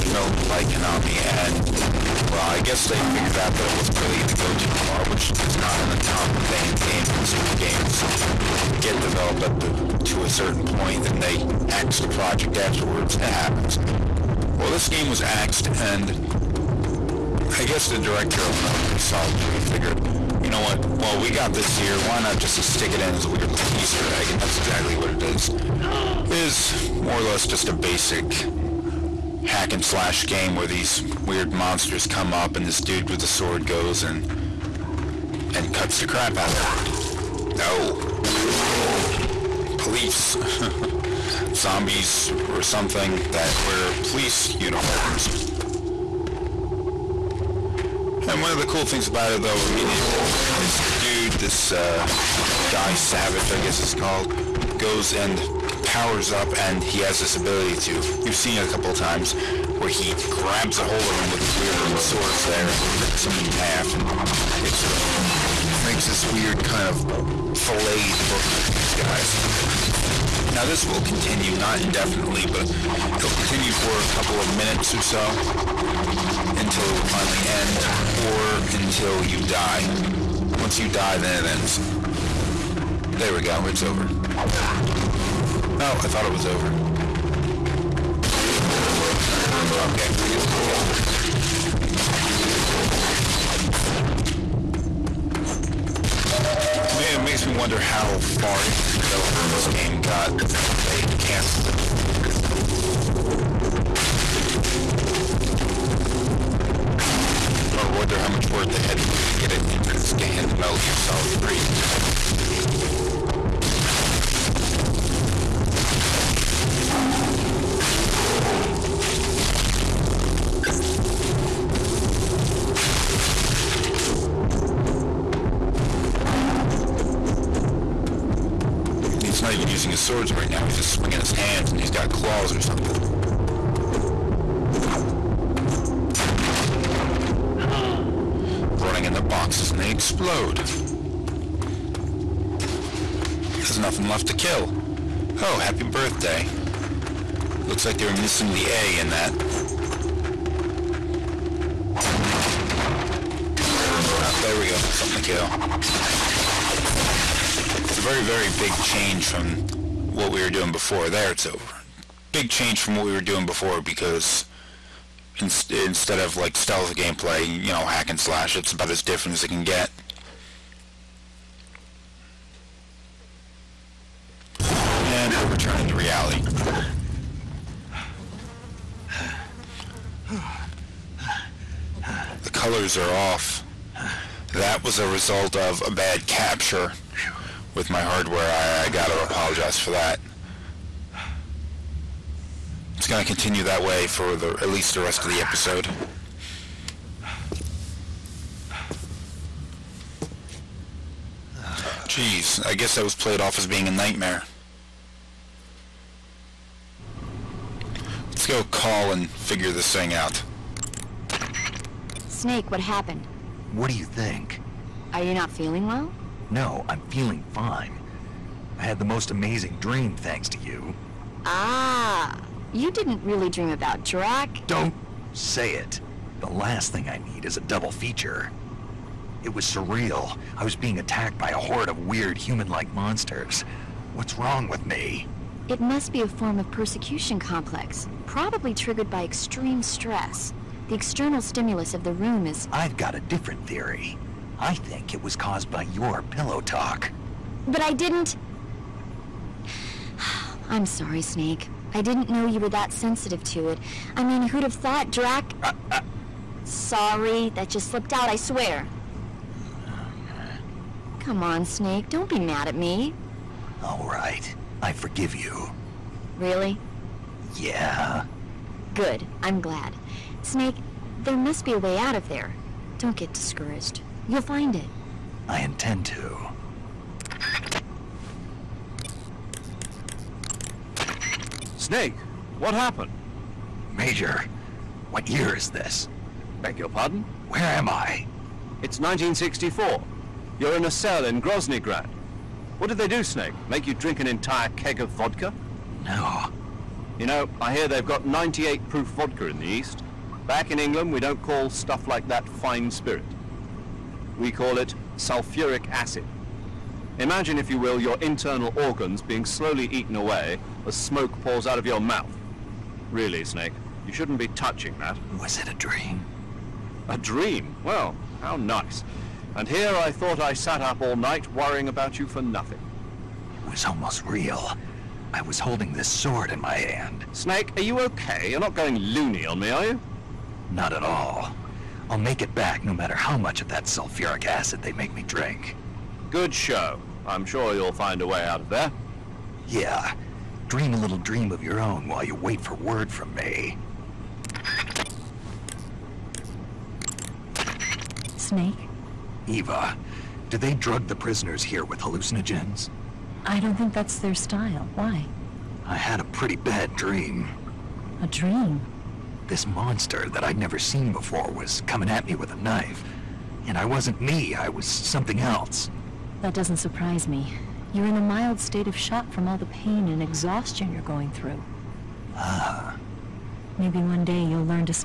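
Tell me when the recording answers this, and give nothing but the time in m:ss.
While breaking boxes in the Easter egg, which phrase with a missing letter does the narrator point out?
2:25.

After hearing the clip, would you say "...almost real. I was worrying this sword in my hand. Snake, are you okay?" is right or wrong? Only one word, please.
wrong.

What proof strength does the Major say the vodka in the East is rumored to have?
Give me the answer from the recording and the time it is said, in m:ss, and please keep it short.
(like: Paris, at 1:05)
98 proof, at 4:58.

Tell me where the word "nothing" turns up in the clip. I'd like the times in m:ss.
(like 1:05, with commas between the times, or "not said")
2:23, 5:22.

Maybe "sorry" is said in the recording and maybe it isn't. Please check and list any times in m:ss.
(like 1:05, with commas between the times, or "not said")
4:10, 4:16.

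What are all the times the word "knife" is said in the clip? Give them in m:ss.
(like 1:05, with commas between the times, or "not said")
6:02.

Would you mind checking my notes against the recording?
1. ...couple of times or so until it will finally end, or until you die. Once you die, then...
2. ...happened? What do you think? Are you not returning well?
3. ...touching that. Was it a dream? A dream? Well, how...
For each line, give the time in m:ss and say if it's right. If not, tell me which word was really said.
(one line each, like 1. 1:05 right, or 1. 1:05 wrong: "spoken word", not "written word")
1. 1:14 wrong: "minutes", not "times"
2. 3:32 wrong: "feeling", not "returning"
3. 5:14 right.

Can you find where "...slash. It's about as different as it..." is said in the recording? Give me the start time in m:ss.
2:48.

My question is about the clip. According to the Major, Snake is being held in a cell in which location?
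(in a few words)
Groznygrad.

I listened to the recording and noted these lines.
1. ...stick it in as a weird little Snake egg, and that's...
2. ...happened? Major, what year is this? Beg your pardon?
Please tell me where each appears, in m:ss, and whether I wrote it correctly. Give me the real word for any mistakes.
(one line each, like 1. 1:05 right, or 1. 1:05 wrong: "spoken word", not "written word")
1. 0:22 wrong: "Easter", not "Snake"
2. 4:42 right.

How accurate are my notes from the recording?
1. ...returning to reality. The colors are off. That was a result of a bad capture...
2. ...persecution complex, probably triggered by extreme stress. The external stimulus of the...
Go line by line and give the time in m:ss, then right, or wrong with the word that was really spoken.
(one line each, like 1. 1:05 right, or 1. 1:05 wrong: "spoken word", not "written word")
1. 2:55 right
2. 3:56 right.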